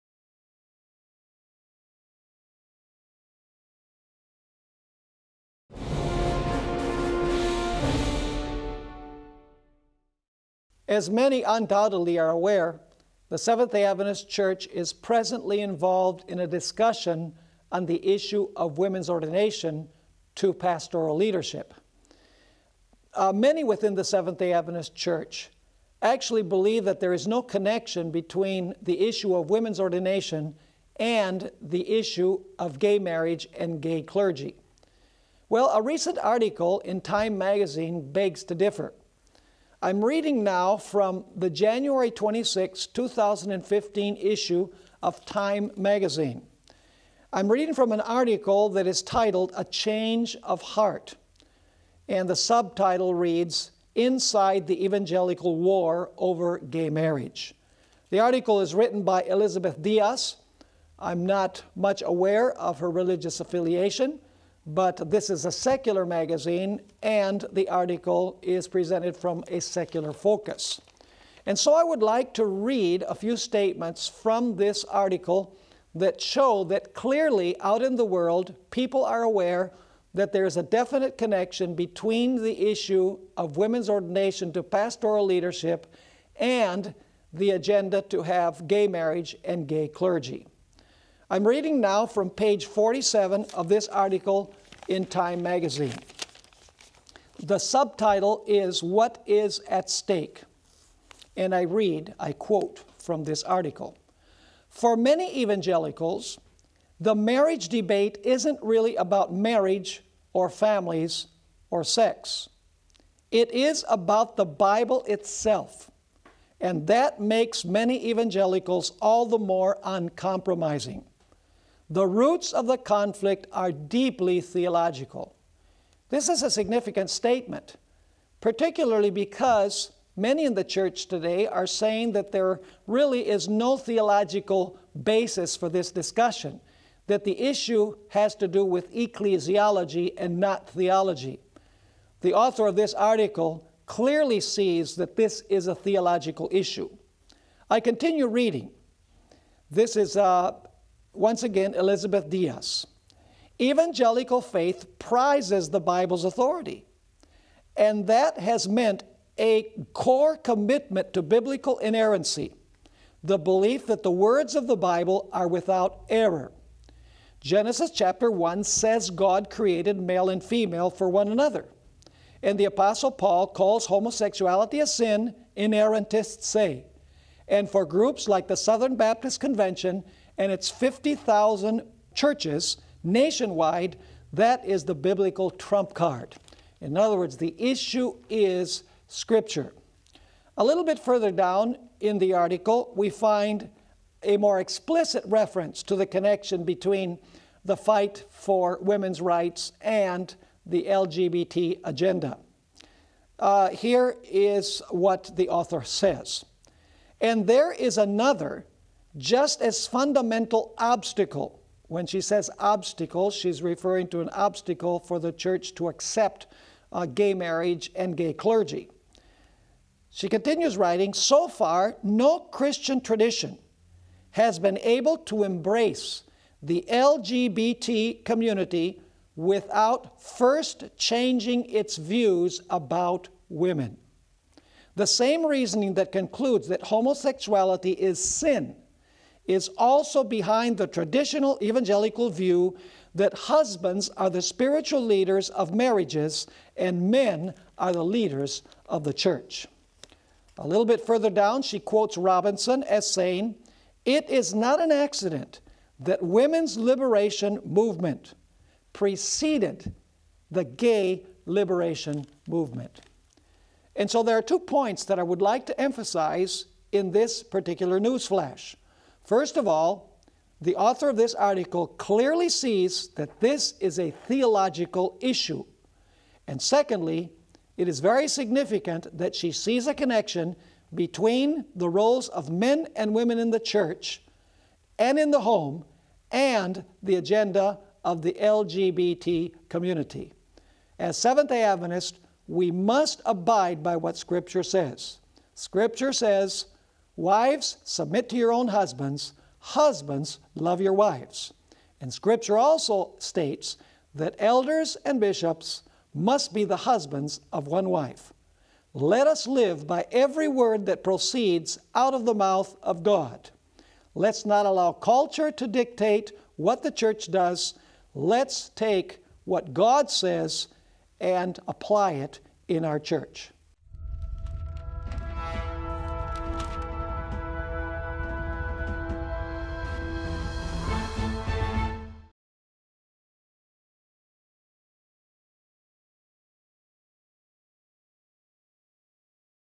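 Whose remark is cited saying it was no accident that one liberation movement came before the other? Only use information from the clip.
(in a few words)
Robinson.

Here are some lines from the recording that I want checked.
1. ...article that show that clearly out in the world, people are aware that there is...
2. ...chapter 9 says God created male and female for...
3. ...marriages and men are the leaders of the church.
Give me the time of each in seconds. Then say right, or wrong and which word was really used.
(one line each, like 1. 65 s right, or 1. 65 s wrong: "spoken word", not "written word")
1. 74 s right
2. 167 s wrong: "1", not "9"
3. 245 s right.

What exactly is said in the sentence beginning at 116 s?
And that makes many evangelicals all the more uncompromising.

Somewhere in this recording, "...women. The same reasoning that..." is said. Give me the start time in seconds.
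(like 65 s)
233 s.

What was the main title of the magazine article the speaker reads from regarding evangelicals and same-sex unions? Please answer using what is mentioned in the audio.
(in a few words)
A Change of Heart.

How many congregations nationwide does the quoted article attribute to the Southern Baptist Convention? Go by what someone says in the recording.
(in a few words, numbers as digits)
50,000.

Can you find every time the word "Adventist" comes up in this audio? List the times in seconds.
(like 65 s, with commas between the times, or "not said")
13 s, 24 s, 291 s.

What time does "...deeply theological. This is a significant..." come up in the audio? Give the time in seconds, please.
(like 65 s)
123 s.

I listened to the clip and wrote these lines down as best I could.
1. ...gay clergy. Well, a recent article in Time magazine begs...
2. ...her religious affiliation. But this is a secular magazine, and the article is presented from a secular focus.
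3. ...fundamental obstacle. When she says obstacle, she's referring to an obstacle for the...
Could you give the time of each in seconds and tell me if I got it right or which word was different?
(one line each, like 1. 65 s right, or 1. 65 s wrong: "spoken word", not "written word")
1. 33 s right
2. 62 s right
3. 209 s right.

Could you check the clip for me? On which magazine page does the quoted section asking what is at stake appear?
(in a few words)
47.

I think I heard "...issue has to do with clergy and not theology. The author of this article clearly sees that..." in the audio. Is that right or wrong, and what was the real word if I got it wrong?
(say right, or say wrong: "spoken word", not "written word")
wrong: "ecclesiology", not "clergy".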